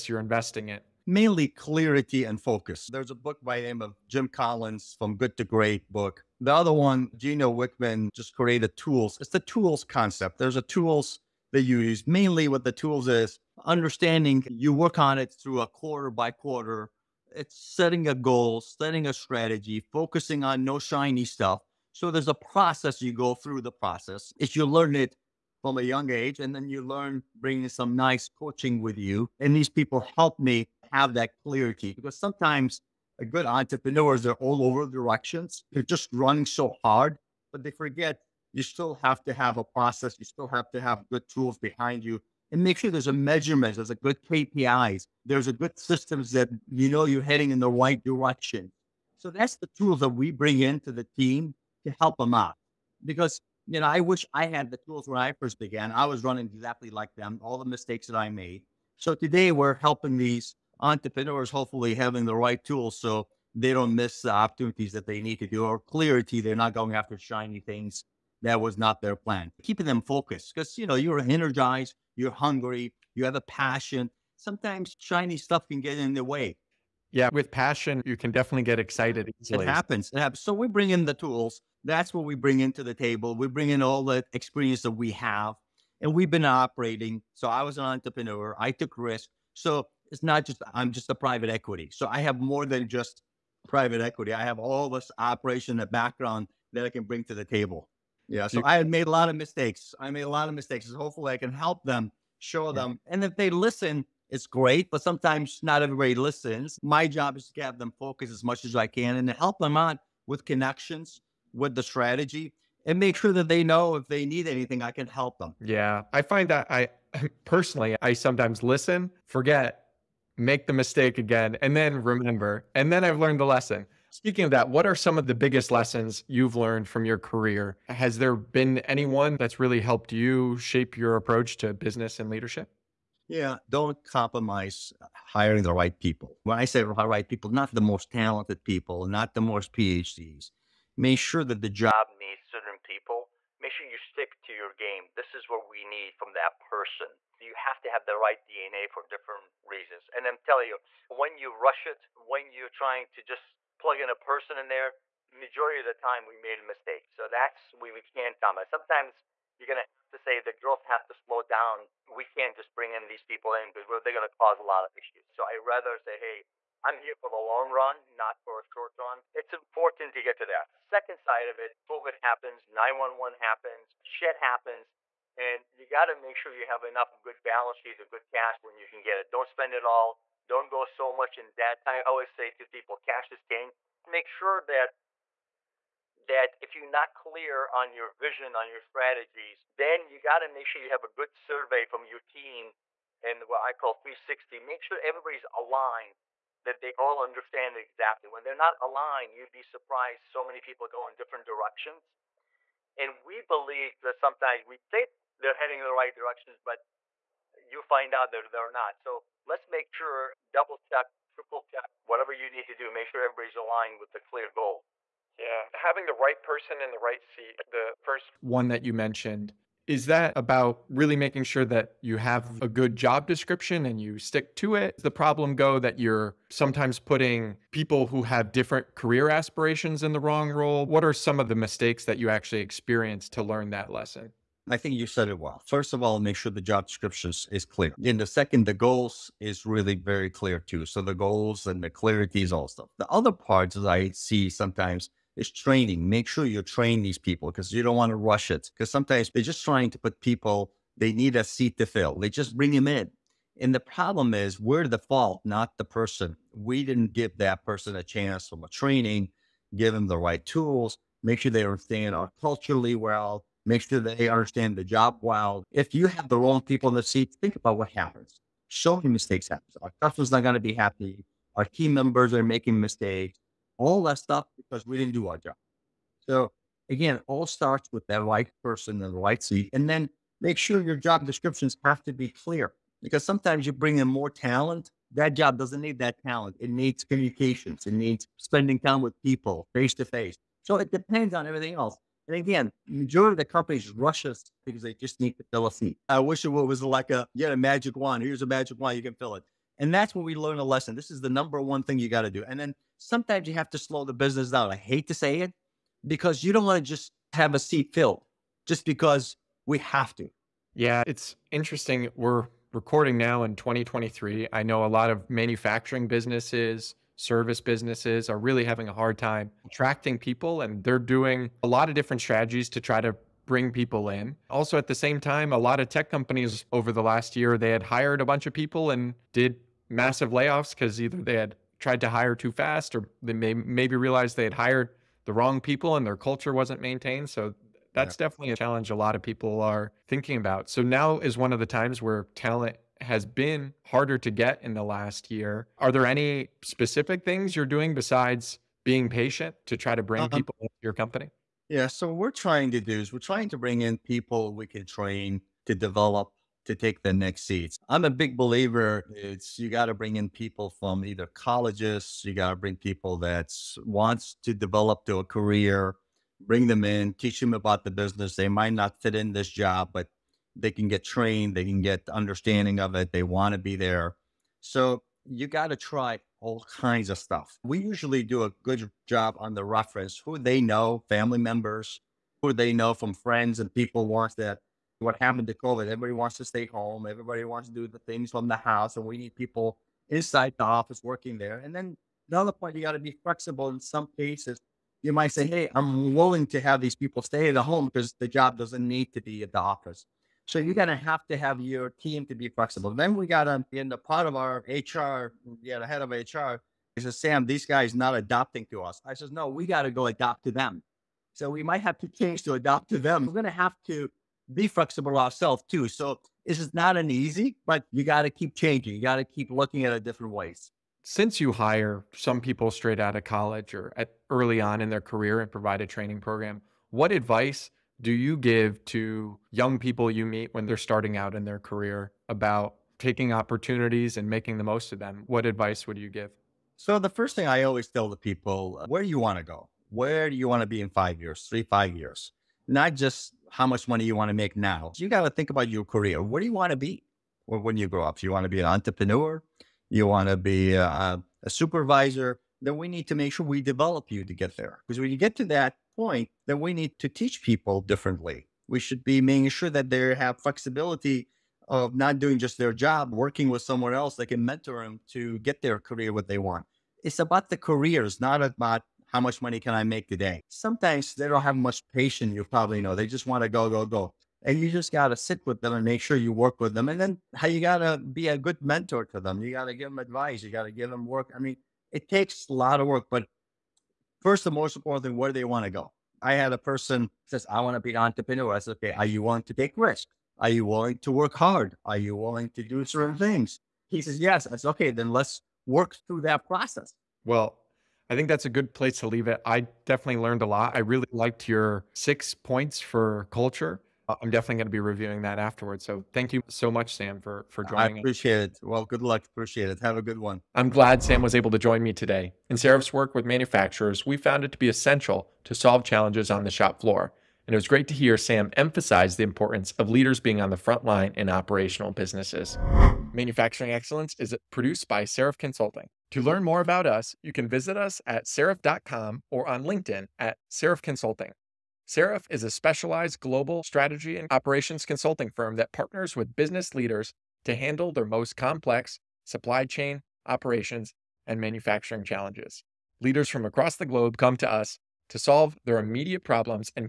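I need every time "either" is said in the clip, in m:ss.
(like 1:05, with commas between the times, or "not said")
5:31, 6:01.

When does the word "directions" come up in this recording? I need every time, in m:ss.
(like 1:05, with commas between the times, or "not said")
0:34, 0:48, 3:21, 3:26.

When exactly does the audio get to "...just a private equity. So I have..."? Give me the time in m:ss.
1:30.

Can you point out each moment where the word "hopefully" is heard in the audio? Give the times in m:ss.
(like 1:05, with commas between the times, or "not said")
1:01, 1:40.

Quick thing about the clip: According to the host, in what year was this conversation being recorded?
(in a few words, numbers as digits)
2023.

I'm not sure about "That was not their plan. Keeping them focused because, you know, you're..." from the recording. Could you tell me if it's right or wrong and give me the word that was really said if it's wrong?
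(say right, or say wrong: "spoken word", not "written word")
right.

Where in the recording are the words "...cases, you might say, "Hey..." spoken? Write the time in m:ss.
6:34.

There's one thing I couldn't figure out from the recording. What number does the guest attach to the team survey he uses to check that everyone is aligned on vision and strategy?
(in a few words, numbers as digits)
360.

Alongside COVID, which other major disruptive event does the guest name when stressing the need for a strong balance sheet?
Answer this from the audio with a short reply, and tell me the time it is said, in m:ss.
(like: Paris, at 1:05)
9/11, at 2:52.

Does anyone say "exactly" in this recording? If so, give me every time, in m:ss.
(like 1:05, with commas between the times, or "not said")
0:56, 3:17.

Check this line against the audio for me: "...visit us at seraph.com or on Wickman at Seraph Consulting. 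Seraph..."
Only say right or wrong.
wrong.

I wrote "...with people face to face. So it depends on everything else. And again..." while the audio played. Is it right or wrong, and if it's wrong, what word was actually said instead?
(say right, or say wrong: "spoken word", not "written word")
right.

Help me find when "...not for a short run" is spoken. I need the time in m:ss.
2:48.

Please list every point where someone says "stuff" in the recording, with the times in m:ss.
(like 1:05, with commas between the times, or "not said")
0:21, 1:15, 4:02, 4:34, 6:17.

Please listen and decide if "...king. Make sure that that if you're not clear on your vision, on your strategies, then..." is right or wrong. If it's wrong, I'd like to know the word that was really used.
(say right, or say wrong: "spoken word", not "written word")
right.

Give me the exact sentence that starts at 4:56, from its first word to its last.
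I wish it was like a you had a magic wand.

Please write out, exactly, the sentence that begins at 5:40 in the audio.
So now is one of the times where talent has been harder to get in the last year.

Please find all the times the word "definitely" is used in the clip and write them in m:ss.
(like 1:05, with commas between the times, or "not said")
1:18, 5:38, 8:19, 8:24.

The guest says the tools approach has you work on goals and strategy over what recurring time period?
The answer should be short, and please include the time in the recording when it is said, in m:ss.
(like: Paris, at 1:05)
quarter by quarter, at 0:15.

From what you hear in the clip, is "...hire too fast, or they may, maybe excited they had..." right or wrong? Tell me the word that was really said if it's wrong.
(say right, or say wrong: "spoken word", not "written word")
wrong: "realized", not "excited".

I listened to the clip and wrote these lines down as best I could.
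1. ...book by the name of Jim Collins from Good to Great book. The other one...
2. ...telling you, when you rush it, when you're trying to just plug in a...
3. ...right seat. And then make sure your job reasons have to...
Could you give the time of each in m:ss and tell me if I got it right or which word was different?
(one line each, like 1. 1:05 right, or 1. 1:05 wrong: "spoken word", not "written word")
1. 0:03 right
2. 2:30 right
3. 4:39 wrong: "descriptions", not "reasons".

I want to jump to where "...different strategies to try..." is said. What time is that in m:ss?
5:21.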